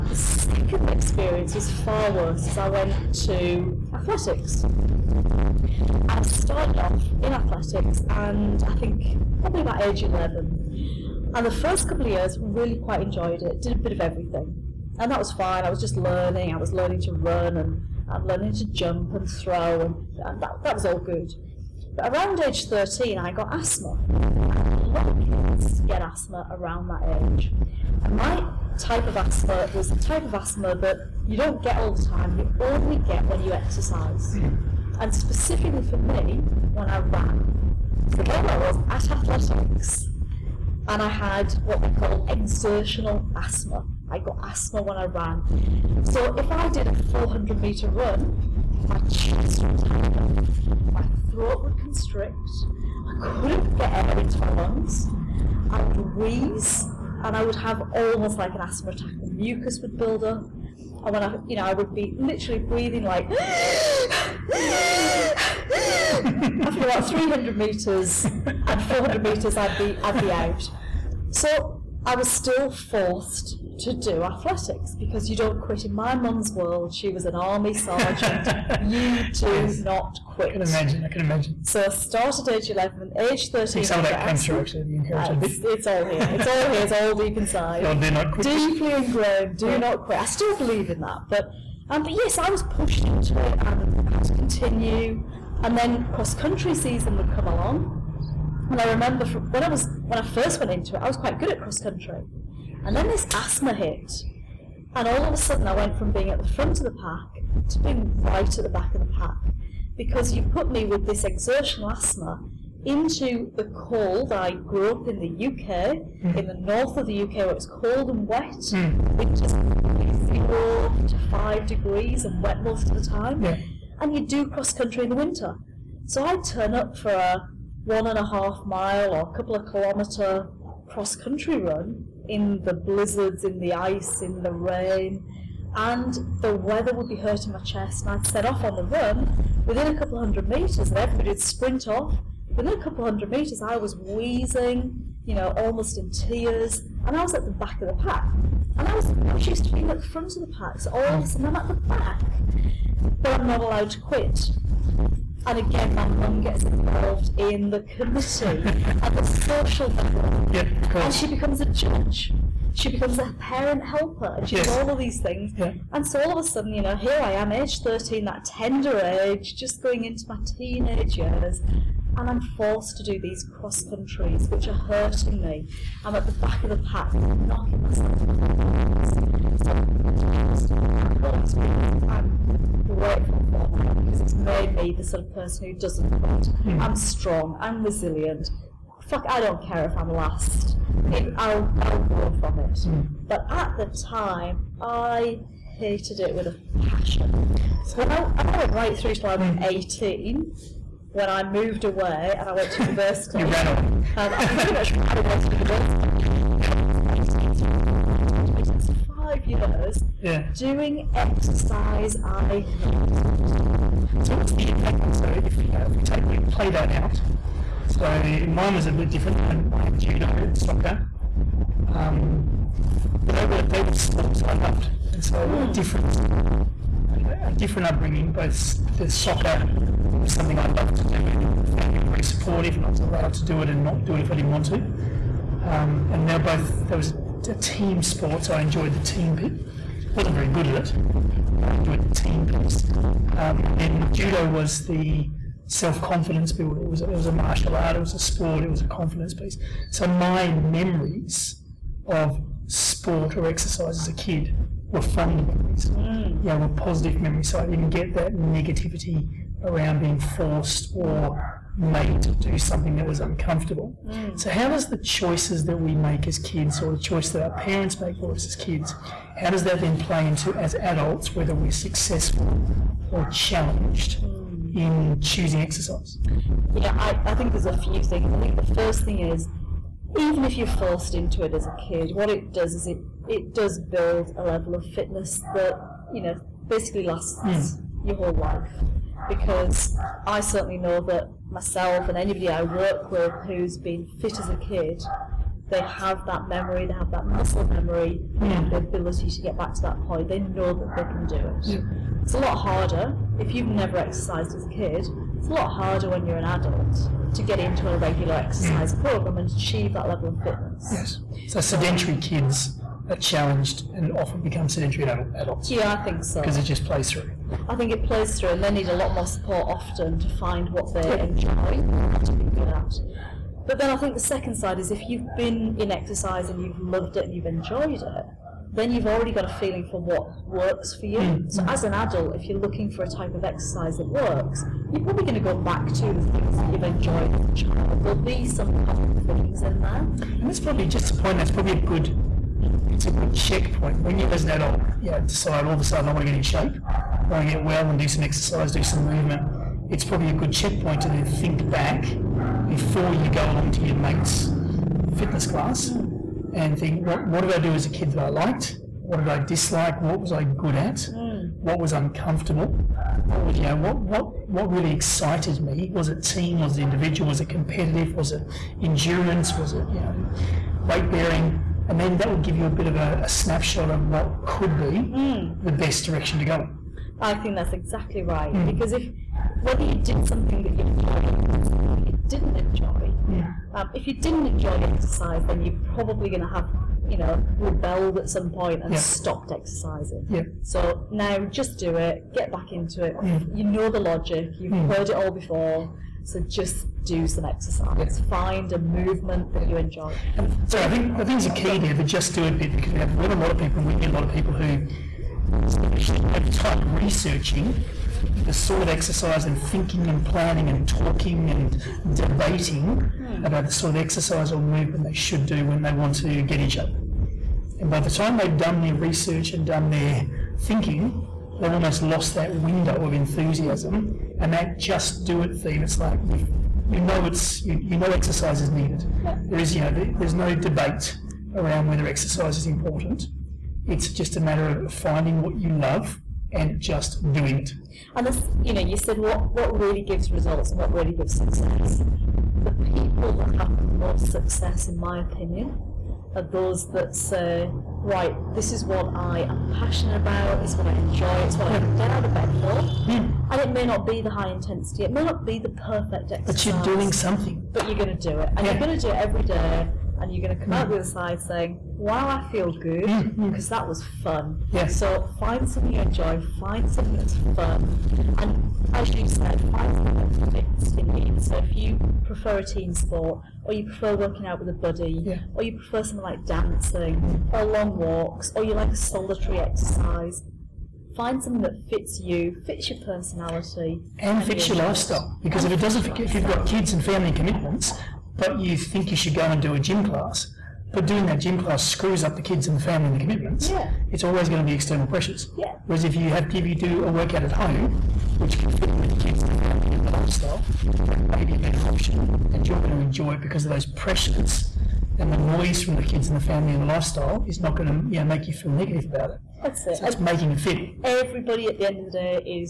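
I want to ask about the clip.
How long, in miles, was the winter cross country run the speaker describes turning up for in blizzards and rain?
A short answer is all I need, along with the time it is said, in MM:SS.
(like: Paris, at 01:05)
one and a half mile, at 02:07.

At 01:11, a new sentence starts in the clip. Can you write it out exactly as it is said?
So I was still forced to do athletics because you don't quit.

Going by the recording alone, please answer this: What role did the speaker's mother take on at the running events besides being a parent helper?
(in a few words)
judge.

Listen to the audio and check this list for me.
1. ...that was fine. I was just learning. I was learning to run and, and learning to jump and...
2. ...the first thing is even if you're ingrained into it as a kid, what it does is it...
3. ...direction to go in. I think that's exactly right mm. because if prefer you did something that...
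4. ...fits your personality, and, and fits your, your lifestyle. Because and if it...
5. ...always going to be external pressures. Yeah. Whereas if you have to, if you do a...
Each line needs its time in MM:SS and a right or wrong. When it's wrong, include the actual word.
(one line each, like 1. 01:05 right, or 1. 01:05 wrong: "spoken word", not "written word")
1. 00:15 right
2. 04:38 wrong: "forced", not "ingrained"
3. 06:16 wrong: "whether", not "prefer"
4. 08:02 right
5. 08:14 right.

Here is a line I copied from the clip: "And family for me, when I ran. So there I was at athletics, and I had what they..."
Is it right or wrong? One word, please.
wrong.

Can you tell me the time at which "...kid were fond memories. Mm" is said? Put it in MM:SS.
04:14.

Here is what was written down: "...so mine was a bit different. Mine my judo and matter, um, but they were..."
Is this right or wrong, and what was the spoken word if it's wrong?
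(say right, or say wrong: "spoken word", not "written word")
wrong: "soccer", not "matter".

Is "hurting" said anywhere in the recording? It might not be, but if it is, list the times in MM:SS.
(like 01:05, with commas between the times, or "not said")
02:17, 02:54.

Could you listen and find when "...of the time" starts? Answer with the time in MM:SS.
02:02.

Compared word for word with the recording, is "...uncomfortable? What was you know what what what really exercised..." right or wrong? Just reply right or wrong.
wrong.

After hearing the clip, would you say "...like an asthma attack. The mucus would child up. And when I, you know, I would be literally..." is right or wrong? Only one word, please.
wrong.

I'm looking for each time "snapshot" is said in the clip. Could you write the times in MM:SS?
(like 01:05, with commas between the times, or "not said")
06:13.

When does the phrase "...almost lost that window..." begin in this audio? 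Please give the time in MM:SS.
07:01.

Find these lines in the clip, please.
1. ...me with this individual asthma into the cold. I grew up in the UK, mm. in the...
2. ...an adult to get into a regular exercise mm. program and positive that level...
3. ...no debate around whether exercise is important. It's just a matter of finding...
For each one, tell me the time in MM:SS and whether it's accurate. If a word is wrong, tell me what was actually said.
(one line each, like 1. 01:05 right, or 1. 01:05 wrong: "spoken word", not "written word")
1. 01:50 wrong: "exertional", not "individual"
2. 05:06 wrong: "achieve", not "positive"
3. 07:10 right.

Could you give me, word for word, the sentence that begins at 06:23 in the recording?
um, if you didn't enjoy exercise, then you're probably going to have you know rebelled at some point and yeah.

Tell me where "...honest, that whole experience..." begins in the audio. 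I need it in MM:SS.
03:00.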